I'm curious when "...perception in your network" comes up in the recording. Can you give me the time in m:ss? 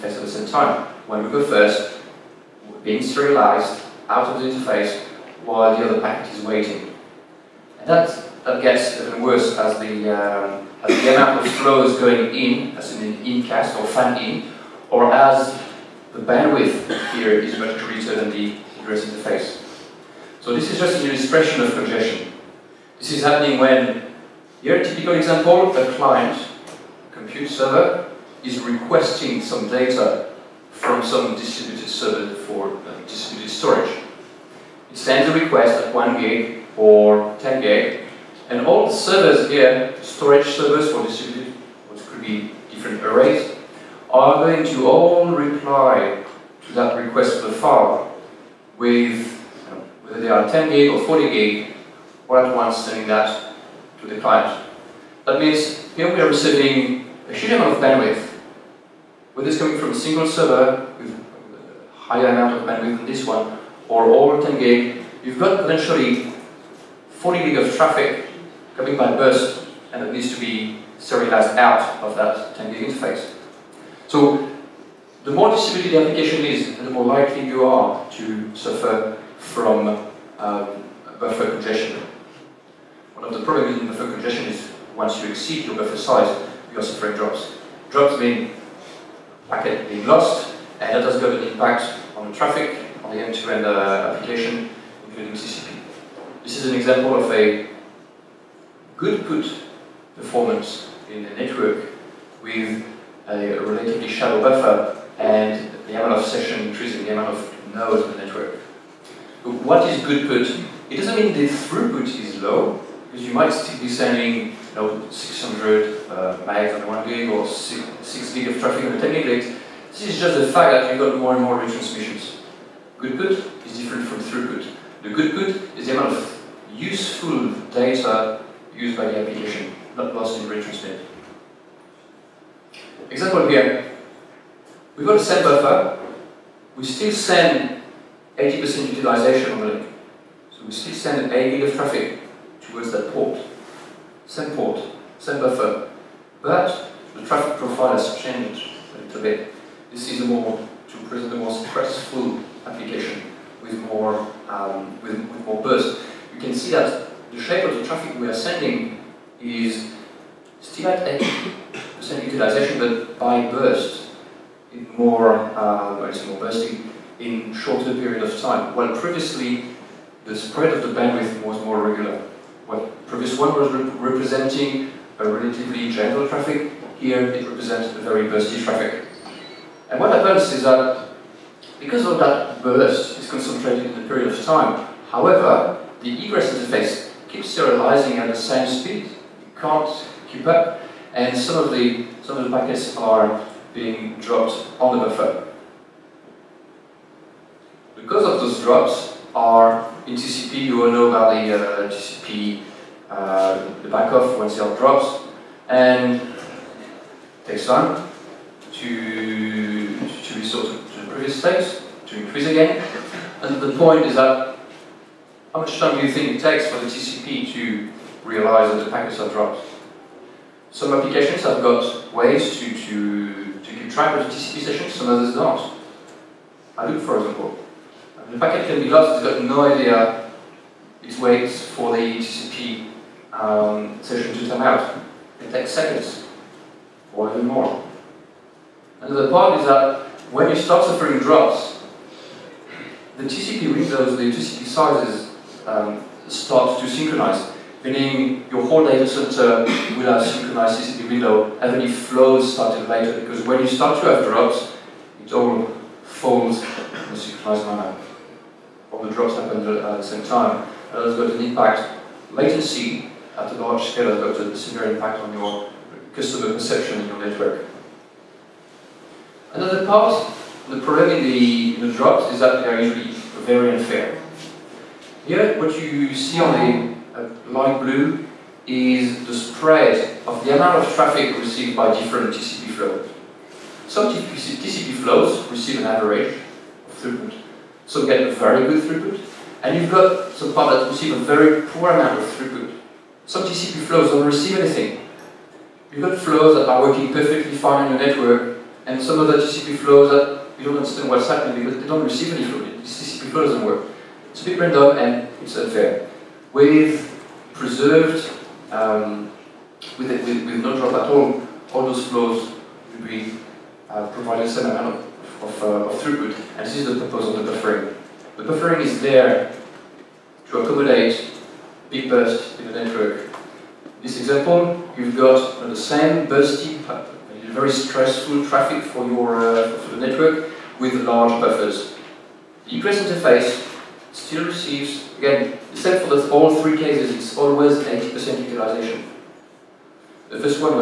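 4:26.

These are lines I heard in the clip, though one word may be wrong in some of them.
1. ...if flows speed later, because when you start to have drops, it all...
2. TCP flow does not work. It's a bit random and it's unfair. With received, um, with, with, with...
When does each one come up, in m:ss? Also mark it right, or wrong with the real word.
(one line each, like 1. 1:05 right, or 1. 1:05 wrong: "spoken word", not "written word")
1. 4:11 wrong: "started", not "speed"
2. 5:02 wrong: "preserved", not "received".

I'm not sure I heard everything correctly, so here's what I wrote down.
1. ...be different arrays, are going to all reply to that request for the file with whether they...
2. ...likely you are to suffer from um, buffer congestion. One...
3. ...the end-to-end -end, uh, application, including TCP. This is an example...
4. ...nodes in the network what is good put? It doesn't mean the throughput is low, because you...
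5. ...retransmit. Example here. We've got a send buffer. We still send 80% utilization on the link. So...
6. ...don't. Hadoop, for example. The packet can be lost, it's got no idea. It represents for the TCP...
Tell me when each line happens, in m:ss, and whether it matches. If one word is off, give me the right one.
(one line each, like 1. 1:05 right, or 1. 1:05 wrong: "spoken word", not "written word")
1. 0:42 right
2. 1:17 right
3. 1:33 right
4. 1:47 right
5. 2:10 right
6. 3:45 wrong: "waits", not "represents".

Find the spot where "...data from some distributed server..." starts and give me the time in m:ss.
0:29.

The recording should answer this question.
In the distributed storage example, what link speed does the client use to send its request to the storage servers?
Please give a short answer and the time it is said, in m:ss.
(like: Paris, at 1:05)
1 gig or 10 gig, at 0:35.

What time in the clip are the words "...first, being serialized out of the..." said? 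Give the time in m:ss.
0:01.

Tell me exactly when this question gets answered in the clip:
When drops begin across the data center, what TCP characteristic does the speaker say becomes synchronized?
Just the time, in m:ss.
4:03.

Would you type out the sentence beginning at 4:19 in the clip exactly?
The drops happen at uh, the same time.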